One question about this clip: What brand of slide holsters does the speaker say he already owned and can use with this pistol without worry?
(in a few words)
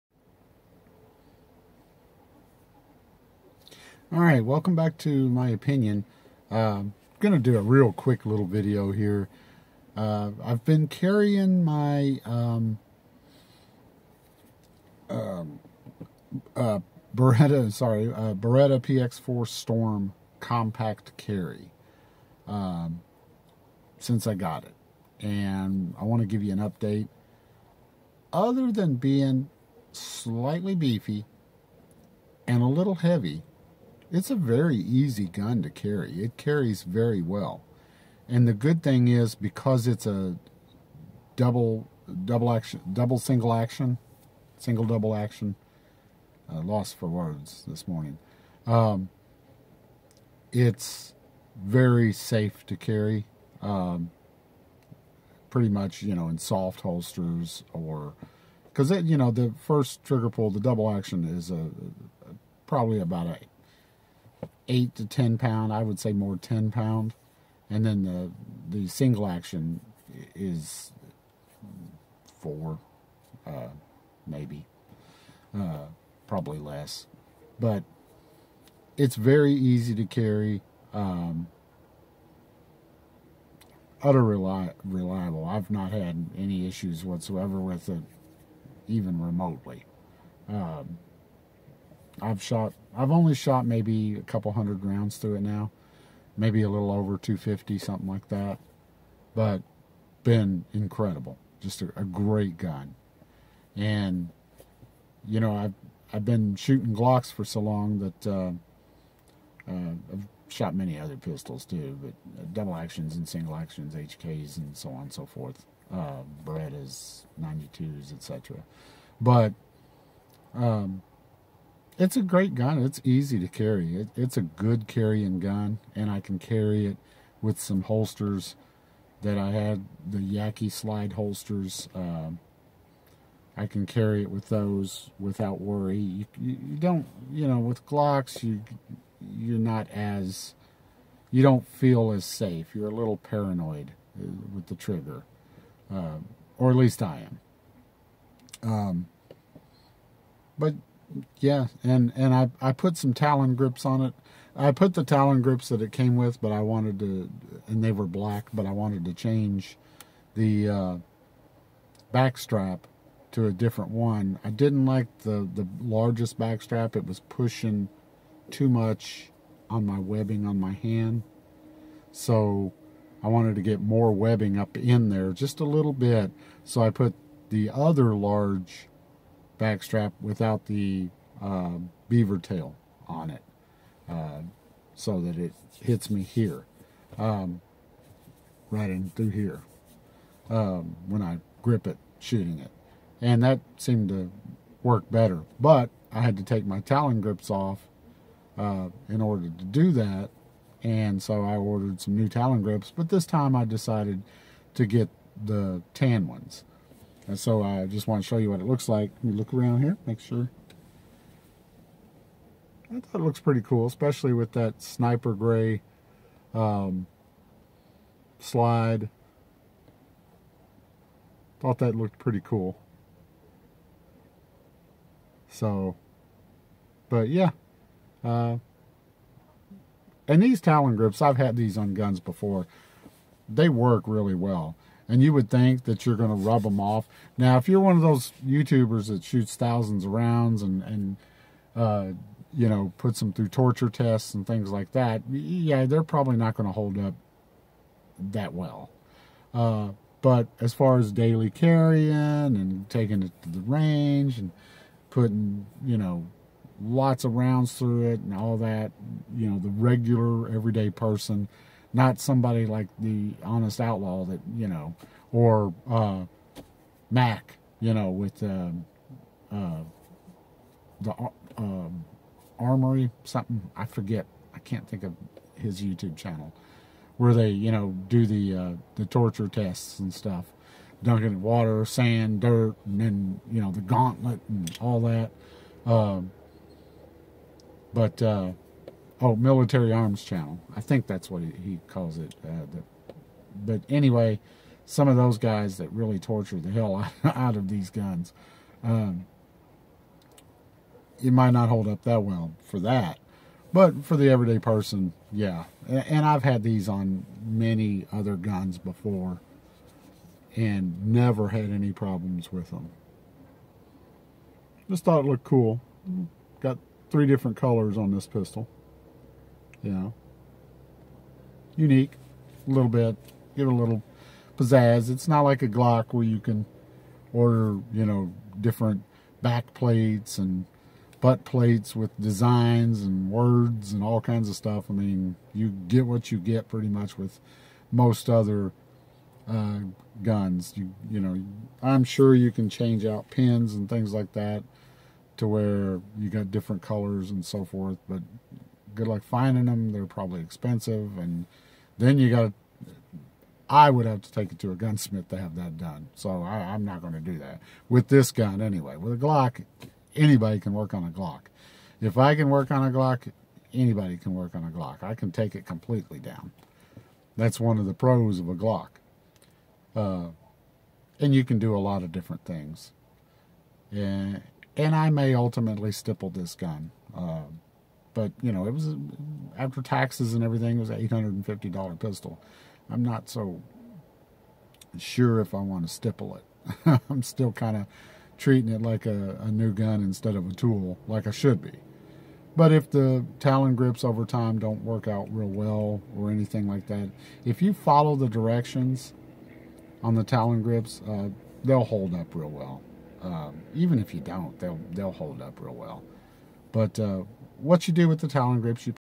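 Yaqui.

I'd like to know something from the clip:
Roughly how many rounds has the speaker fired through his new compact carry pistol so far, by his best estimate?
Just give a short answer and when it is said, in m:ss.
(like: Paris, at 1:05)
250, at 1:37.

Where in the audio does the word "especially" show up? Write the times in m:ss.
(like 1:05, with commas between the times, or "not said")
3:33.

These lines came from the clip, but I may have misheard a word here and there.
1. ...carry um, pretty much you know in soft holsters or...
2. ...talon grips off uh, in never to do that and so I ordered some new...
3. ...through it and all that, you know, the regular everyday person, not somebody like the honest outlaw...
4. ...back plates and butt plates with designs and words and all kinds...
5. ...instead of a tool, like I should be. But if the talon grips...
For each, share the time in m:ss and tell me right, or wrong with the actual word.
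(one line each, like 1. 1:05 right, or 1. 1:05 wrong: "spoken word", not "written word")
1. 0:52 right
2. 3:16 wrong: "order", not "never"
3. 4:17 right
4. 5:29 right
5. 6:30 right.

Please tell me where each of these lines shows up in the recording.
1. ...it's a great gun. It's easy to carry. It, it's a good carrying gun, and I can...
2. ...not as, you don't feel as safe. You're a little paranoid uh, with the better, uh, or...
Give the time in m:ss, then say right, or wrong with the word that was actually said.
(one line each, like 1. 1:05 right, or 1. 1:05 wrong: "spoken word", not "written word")
1. 2:02 right
2. 2:19 wrong: "trigger", not "better".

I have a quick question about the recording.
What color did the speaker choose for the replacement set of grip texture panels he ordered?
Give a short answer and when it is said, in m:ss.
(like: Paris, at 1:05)
tan, at 3:25.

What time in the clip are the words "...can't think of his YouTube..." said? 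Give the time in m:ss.
4:34.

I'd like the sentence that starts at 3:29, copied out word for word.
Let me look around here, make sure.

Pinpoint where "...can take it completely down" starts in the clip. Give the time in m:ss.
6:05.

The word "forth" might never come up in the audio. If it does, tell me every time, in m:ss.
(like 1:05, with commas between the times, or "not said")
1:55, 5:47.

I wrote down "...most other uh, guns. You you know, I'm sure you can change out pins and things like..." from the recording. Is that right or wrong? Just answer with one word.
right.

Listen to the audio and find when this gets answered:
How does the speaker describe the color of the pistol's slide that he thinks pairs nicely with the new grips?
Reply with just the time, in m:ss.
3:34.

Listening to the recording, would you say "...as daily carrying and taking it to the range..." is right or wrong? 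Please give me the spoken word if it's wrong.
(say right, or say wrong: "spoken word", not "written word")
right.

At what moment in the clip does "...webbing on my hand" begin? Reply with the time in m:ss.
2:49.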